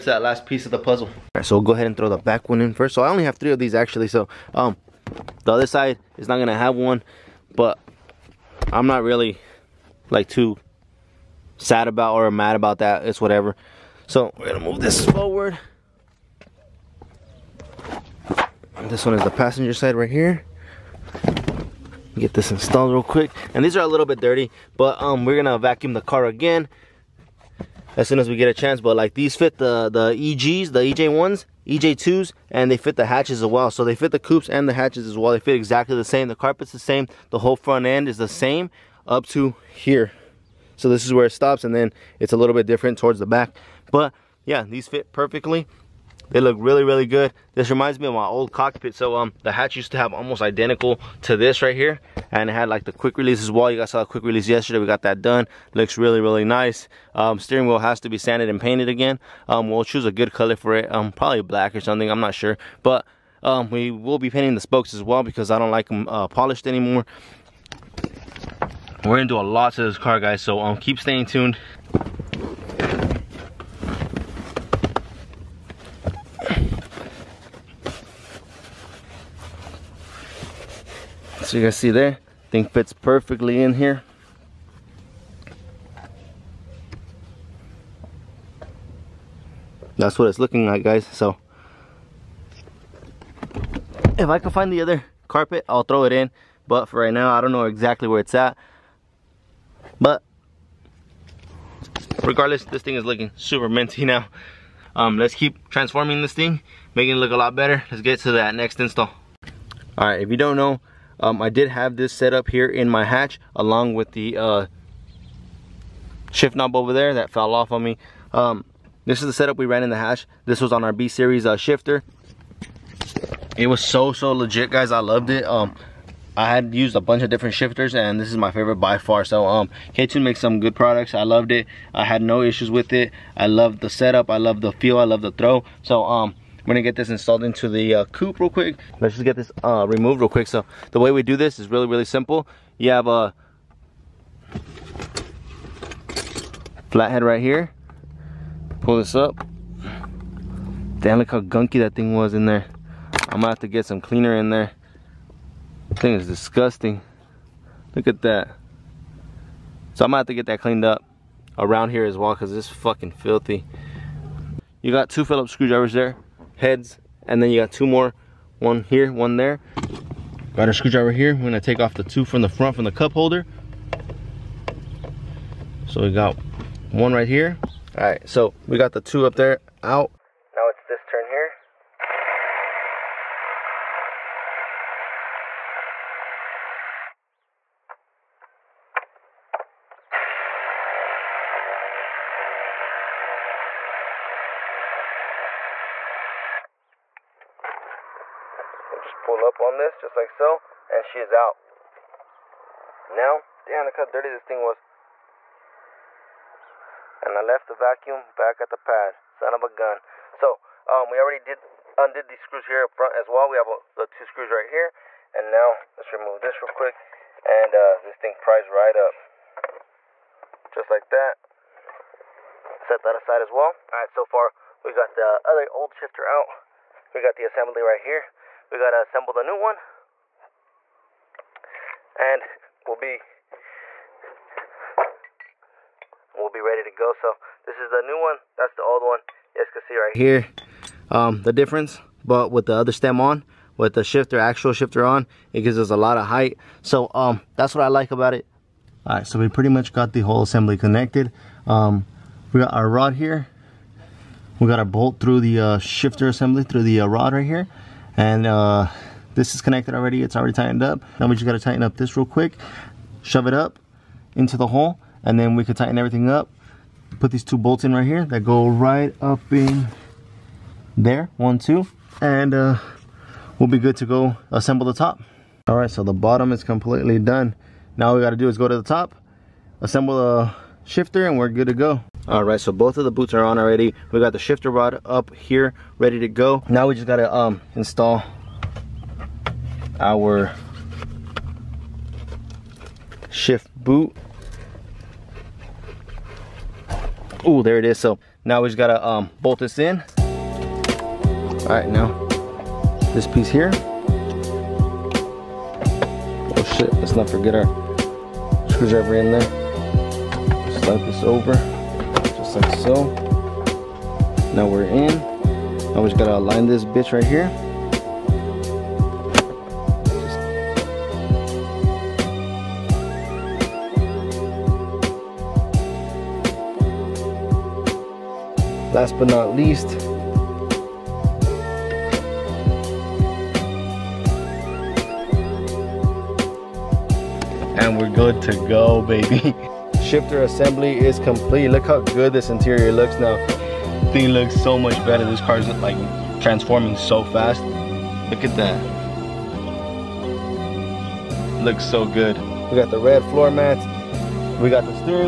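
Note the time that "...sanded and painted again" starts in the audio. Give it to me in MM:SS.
00:58.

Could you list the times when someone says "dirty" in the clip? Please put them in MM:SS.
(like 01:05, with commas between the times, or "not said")
00:24, 03:24.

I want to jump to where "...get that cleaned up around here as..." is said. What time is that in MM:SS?
02:40.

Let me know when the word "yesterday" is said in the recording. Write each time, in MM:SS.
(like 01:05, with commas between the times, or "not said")
00:54.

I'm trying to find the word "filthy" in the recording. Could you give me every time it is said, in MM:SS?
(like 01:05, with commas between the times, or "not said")
02:43.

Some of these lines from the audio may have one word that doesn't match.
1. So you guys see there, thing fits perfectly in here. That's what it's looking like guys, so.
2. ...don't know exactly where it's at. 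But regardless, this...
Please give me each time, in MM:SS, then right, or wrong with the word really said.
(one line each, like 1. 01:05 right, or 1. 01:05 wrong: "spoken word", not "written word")
1. 01:21 right
2. 01:37 right.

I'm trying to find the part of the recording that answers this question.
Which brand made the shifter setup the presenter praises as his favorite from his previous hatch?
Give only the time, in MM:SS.
02:09.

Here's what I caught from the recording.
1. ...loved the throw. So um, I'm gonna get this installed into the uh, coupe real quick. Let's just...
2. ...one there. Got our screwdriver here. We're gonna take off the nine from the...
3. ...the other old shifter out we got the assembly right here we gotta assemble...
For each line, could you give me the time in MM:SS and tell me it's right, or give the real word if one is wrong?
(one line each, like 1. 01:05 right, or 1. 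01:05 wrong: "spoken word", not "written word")
1. 02:15 right
2. 02:49 wrong: "two", not "nine"
3. 03:45 right.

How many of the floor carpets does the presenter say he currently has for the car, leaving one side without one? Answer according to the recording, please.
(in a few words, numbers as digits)
3.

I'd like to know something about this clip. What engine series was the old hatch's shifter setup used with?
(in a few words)
B series.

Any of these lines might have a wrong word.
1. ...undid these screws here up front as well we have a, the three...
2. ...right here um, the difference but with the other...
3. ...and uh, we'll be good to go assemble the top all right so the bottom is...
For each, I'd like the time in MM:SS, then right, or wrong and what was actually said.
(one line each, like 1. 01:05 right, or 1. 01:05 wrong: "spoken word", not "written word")
1. 03:31 wrong: "two", not "three"
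2. 03:59 right
3. 04:32 right.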